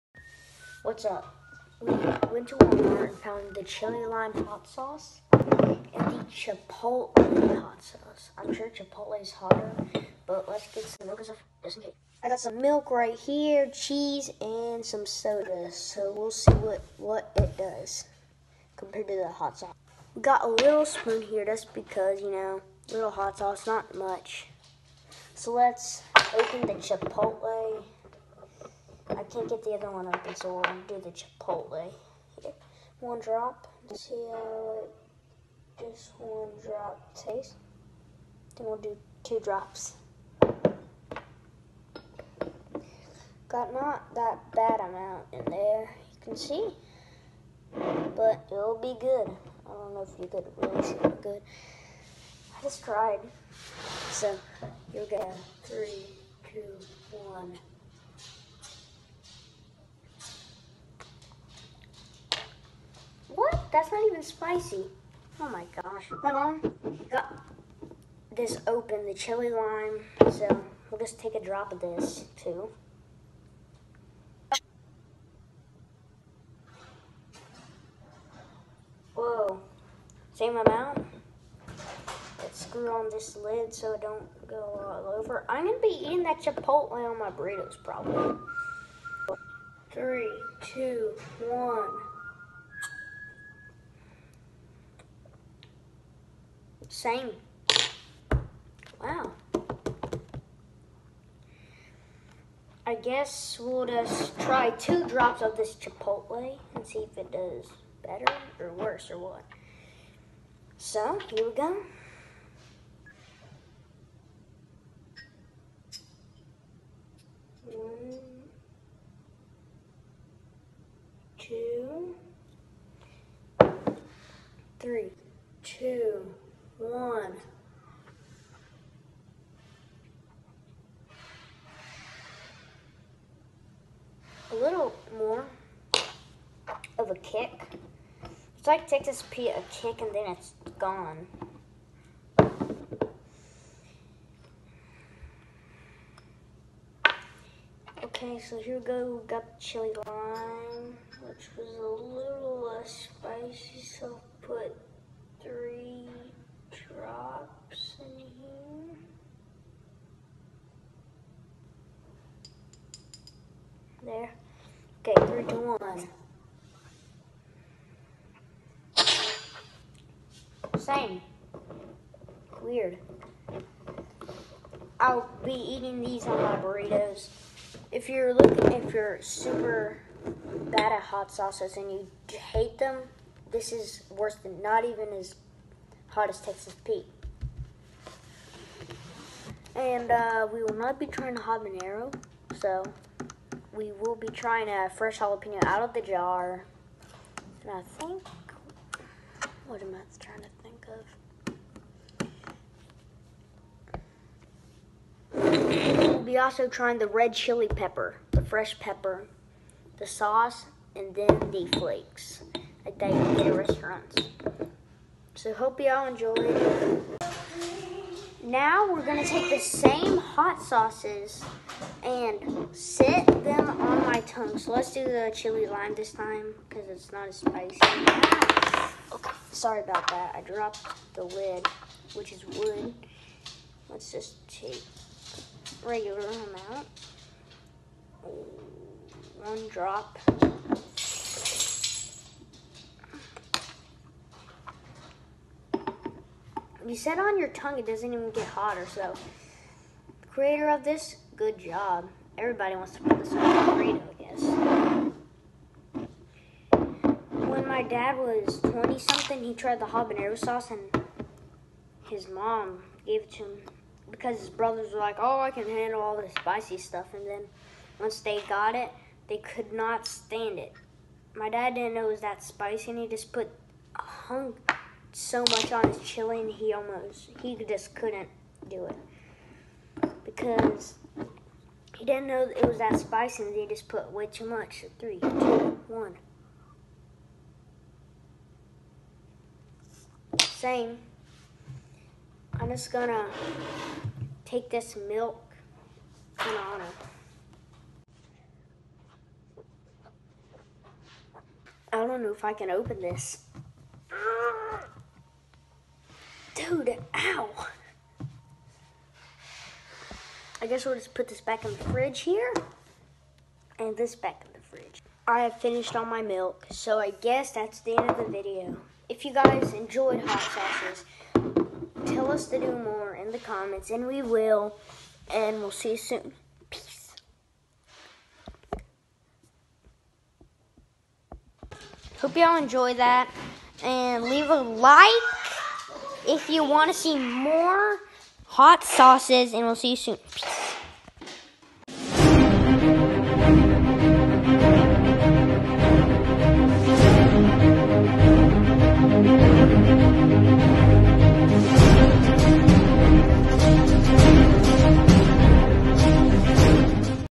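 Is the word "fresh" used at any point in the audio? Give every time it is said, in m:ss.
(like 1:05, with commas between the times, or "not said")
3:14, 3:28.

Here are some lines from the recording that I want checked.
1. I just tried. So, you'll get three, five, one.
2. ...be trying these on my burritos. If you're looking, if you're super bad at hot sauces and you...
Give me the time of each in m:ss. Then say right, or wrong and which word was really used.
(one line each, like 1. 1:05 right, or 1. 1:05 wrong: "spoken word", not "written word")
1. 0:52 wrong: "two", not "five"
2. 2:55 wrong: "eating", not "trying".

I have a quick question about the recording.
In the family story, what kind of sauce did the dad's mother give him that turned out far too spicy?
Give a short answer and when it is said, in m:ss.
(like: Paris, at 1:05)
Habanero sauce, at 4:19.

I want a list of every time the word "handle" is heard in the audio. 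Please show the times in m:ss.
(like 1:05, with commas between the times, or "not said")
4:25.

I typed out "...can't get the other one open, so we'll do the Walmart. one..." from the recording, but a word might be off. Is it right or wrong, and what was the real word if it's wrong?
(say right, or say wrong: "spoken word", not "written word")
wrong: "Chipotle", not "Walmart".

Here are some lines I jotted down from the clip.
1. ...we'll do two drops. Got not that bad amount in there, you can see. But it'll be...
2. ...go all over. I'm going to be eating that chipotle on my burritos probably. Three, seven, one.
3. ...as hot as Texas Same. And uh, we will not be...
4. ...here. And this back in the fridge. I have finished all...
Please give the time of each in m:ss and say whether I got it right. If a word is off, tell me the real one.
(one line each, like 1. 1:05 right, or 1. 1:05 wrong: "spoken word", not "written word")
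1. 0:38 right
2. 1:24 wrong: "two", not "seven"
3. 3:05 wrong: "Pete", not "Same"
4. 5:12 right.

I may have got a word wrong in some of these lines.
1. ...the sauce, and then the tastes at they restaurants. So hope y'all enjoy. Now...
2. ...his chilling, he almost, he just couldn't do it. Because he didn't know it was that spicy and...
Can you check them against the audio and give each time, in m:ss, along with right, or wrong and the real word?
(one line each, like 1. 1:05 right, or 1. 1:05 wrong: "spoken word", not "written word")
1. 3:29 wrong: "flakes", not "tastes"
2. 4:35 right.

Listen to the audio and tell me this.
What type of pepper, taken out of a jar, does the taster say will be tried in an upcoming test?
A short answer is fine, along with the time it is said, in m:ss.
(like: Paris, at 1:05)
Jalapeno, at 3:15.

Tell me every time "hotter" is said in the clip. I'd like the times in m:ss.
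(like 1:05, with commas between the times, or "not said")
0:09, 4:08.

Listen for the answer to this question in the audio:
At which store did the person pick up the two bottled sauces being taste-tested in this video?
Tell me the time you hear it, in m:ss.
0:02.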